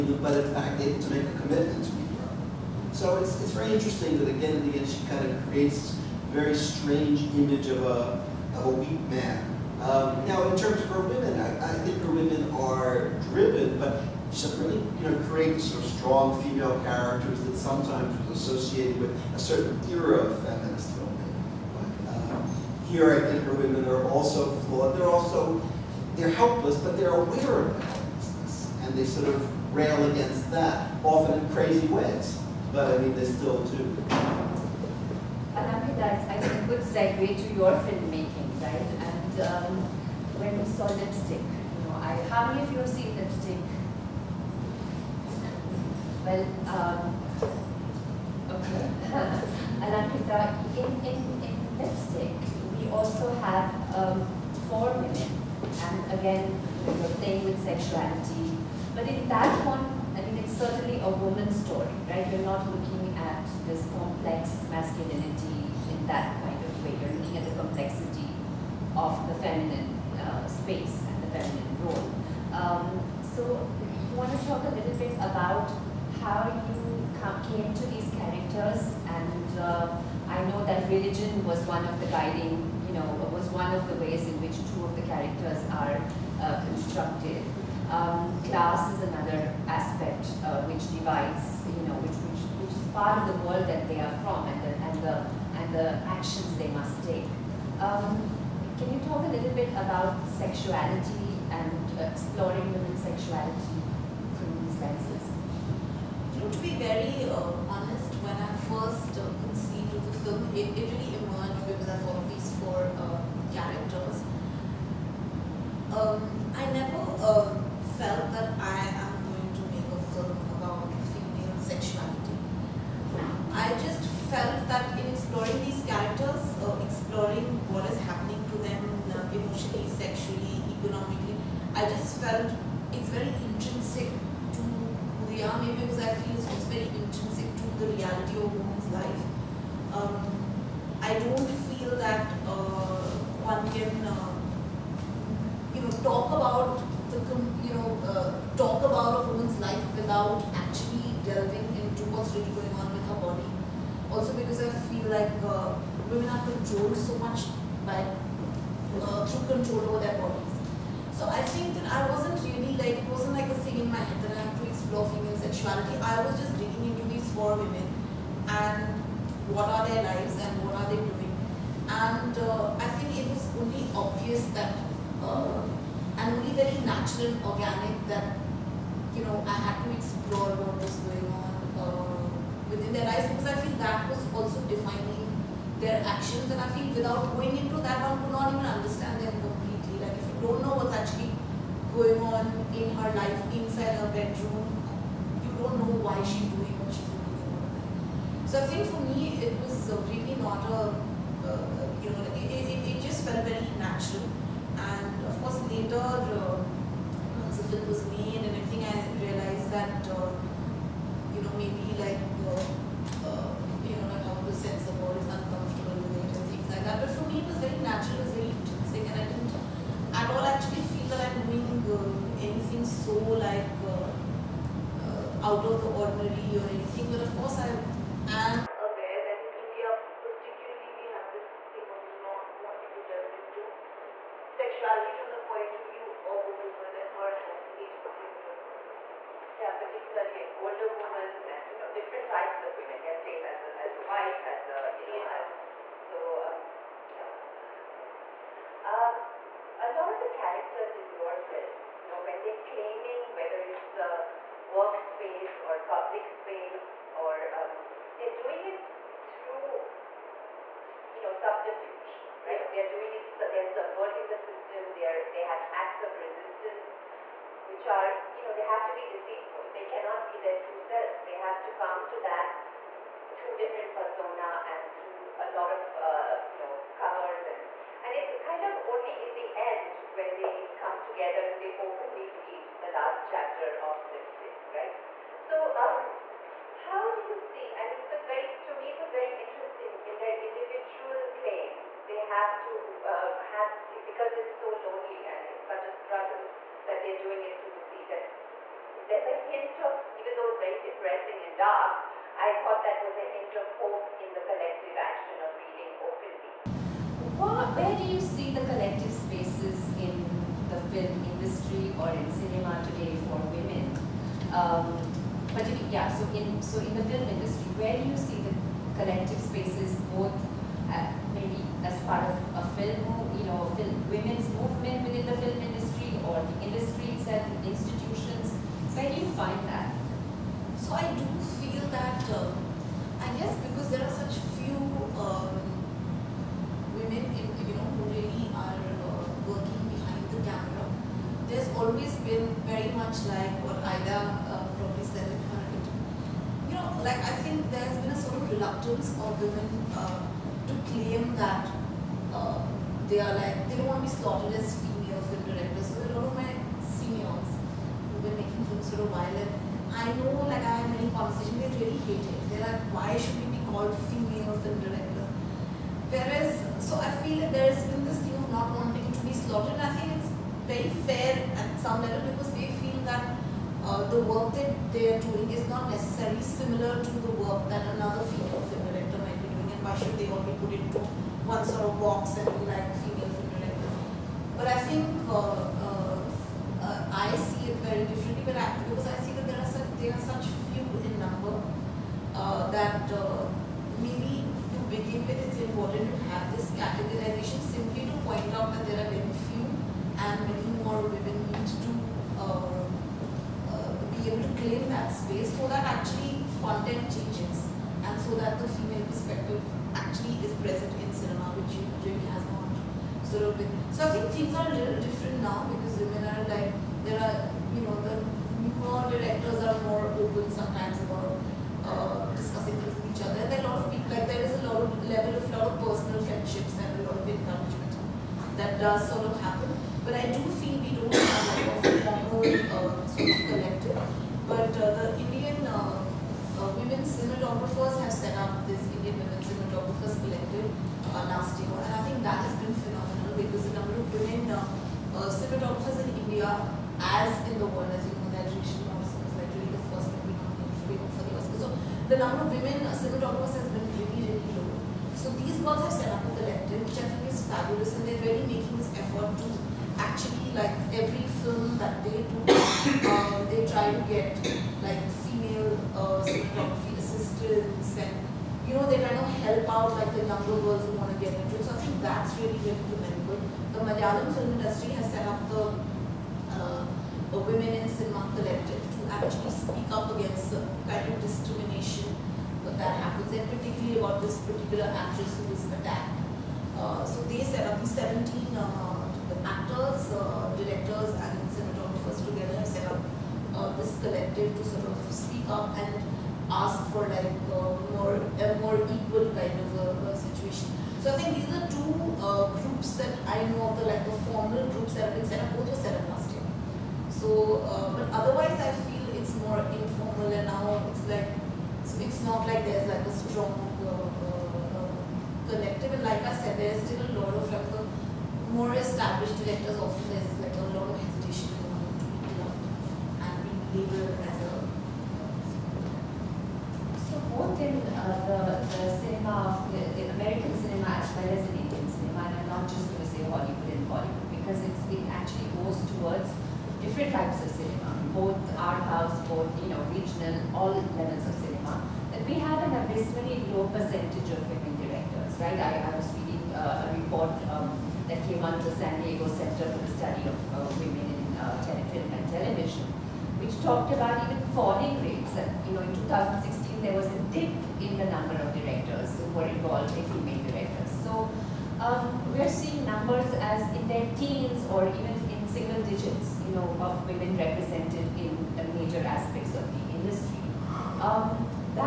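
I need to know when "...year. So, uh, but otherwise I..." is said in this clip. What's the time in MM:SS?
08:26.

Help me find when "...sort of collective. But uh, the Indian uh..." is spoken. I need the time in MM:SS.
07:13.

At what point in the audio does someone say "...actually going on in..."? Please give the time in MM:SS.
03:10.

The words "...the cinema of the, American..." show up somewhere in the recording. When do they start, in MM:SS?
08:48.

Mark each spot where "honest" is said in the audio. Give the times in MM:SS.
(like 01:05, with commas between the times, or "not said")
01:47.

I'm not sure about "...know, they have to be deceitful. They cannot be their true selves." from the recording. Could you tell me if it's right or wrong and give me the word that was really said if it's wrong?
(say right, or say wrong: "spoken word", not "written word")
right.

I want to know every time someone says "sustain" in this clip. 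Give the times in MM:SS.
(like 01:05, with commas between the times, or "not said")
not said.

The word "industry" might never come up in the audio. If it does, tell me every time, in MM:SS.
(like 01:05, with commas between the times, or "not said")
05:11, 05:17, 07:54, 09:29.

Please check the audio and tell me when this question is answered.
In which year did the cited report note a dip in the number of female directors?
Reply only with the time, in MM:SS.
09:16.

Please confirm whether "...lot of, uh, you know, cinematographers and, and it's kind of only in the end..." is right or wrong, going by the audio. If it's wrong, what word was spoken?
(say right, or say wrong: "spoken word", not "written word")
wrong: "covers", not "cinematographers".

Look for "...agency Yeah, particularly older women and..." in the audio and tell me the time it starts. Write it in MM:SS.
03:57.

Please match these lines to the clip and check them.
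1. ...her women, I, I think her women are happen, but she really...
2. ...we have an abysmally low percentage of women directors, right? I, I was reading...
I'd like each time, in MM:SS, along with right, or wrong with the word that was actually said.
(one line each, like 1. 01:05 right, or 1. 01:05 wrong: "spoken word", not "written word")
1. 00:10 wrong: "driven", not "happen"
2. 09:02 right.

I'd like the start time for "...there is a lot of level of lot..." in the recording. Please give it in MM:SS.
07:04.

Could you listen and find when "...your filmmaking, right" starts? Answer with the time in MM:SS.
00:37.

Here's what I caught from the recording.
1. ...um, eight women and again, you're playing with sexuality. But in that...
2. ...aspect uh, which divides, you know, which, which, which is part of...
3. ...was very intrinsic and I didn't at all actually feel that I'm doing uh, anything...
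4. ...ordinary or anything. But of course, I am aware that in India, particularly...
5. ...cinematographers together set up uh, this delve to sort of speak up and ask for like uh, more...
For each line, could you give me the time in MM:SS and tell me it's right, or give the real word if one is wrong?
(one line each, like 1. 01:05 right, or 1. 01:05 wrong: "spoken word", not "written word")
1. 00:53 wrong: "four", not "eight"
2. 01:29 right
3. 03:38 right
4. 03:45 right
5. 08:11 wrong: "collective", not "delve".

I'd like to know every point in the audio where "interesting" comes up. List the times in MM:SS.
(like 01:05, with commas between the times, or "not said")
00:03, 04:49.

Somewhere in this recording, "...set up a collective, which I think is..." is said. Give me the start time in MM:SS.
07:35.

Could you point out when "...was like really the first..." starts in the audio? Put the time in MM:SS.
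07:28.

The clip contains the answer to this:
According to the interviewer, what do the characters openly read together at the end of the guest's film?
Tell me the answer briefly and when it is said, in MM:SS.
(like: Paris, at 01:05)
The last chapter of Lipstick, at 04:42.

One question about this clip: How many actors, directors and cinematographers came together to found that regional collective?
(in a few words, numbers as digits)
17.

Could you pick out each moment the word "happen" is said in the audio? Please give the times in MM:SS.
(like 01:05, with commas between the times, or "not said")
07:09, 08:03.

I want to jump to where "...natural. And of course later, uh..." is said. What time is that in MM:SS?
03:23.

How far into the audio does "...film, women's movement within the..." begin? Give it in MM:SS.
05:23.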